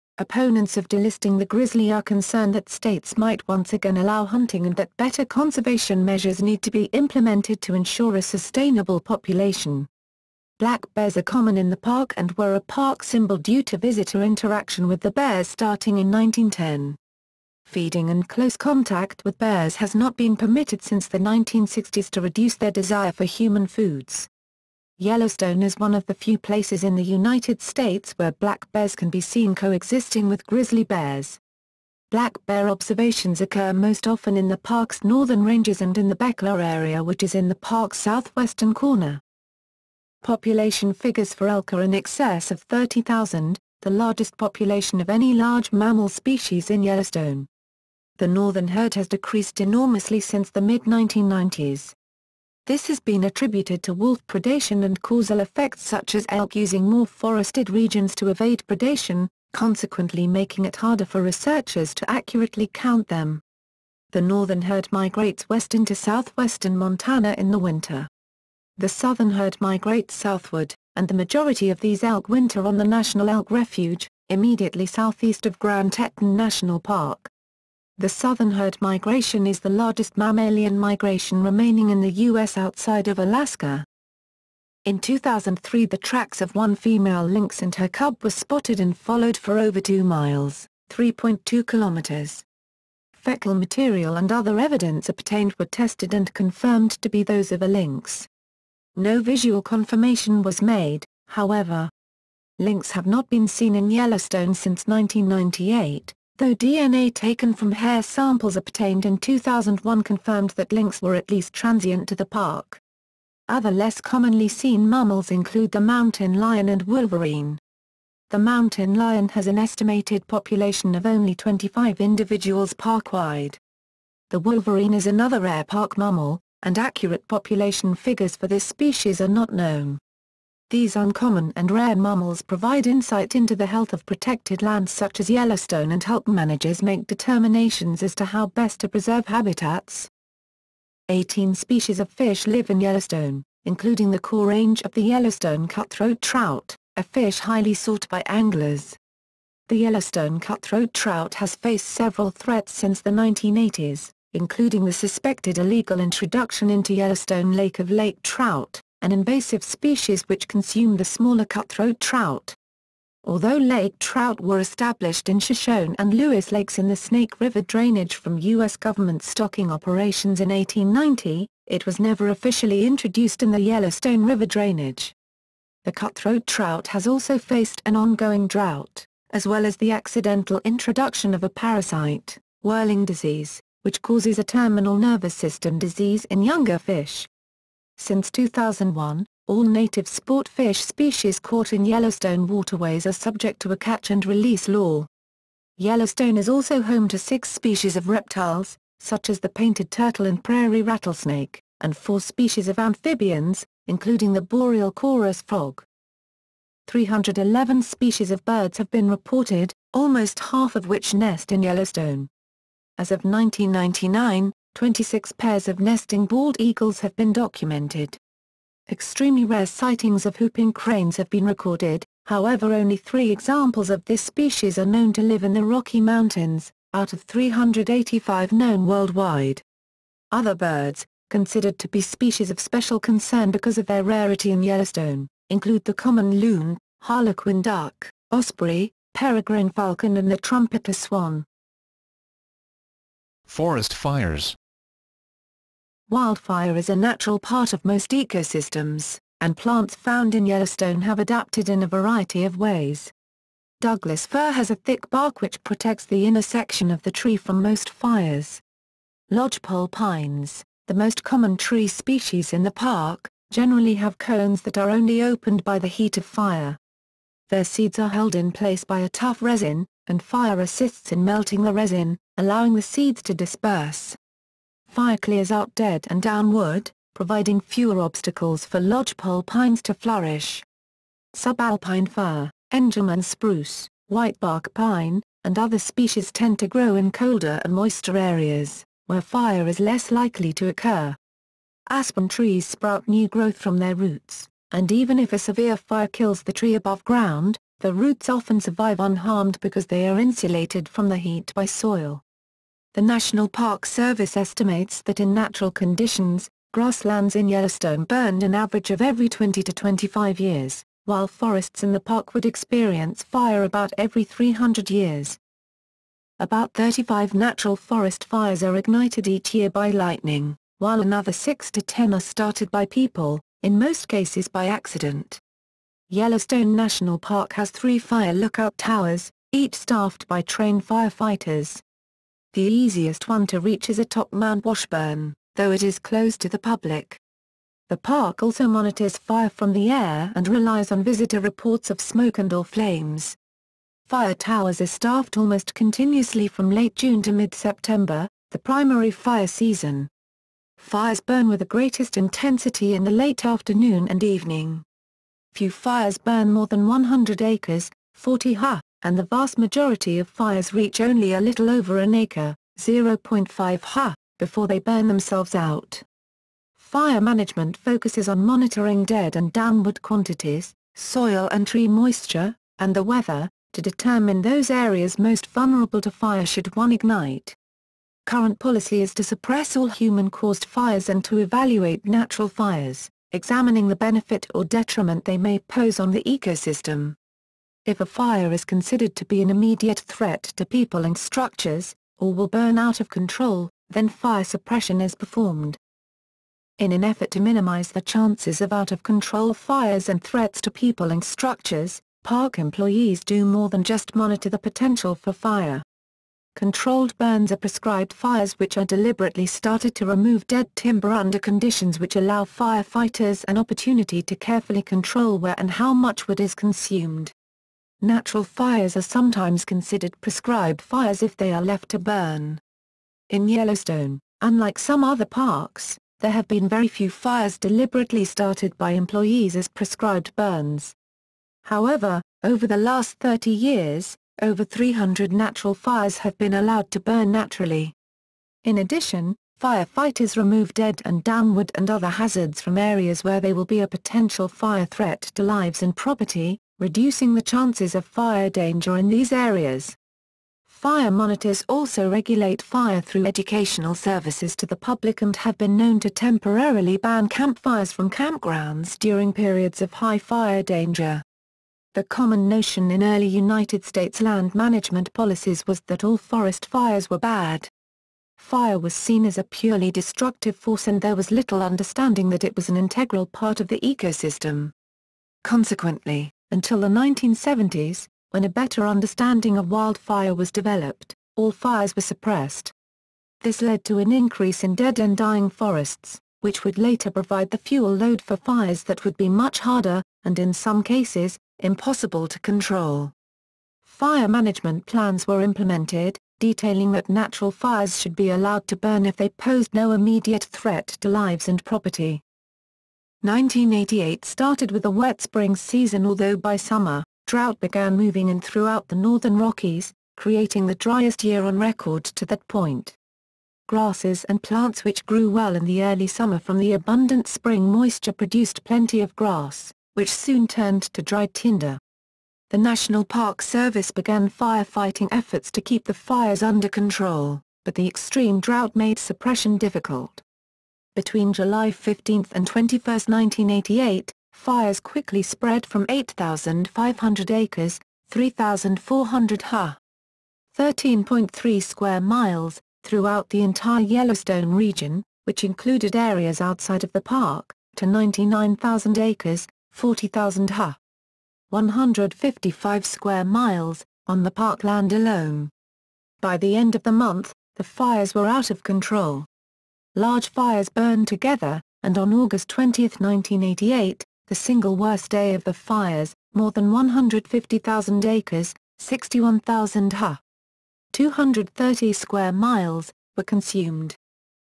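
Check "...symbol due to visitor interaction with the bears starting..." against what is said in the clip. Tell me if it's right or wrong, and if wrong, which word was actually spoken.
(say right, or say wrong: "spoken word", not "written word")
right.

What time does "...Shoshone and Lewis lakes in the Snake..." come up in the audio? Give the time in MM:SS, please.
02:45.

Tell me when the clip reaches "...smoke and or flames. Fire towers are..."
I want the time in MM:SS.
05:41.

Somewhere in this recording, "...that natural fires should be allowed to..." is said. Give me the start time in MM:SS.
08:16.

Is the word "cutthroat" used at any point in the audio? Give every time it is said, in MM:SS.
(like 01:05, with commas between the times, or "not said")
02:25, 02:30, 02:41, 02:55.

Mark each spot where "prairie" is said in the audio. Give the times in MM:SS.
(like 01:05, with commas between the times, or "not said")
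03:20.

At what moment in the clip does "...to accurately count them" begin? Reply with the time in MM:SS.
01:01.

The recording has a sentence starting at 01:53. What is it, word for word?
Other less commonly seen mammals include the mountain lion and wolverine.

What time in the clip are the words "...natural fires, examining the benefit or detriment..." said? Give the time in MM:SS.
06:22.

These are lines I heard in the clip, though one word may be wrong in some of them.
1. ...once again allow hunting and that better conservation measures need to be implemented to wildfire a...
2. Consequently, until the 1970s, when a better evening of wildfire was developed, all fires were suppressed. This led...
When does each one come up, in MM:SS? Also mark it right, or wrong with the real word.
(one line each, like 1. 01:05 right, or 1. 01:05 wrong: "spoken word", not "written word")
1. 00:03 wrong: "ensure", not "wildfire"
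2. 07:55 wrong: "understanding", not "evening".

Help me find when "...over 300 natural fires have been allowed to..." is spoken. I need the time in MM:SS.
07:14.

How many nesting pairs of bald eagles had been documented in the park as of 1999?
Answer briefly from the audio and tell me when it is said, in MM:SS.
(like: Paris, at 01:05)
26, at 03:34.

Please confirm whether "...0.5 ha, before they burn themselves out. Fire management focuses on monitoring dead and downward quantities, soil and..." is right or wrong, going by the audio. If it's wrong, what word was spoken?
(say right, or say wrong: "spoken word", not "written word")
right.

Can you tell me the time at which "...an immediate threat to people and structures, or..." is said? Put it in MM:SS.
06:29.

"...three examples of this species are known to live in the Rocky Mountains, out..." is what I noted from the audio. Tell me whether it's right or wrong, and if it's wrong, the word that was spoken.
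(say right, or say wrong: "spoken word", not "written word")
right.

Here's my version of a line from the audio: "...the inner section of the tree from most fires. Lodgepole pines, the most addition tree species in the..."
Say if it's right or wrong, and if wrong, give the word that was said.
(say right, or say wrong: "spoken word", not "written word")
wrong: "common", not "addition".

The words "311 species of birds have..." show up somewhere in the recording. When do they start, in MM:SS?
03:26.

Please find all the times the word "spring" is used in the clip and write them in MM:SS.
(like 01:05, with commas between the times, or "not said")
08:25, 08:37.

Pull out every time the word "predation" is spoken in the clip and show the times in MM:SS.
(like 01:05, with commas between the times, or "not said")
00:54, 00:58.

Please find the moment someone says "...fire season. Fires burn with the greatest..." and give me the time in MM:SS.
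05:49.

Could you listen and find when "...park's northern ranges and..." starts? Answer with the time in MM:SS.
00:34.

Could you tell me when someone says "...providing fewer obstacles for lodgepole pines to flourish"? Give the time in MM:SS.
04:37.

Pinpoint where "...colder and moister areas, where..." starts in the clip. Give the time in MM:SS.
04:47.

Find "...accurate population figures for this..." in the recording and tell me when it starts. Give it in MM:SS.
02:06.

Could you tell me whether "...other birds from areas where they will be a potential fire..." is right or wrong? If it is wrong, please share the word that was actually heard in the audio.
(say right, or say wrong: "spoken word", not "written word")
wrong: "hazards", not "birds".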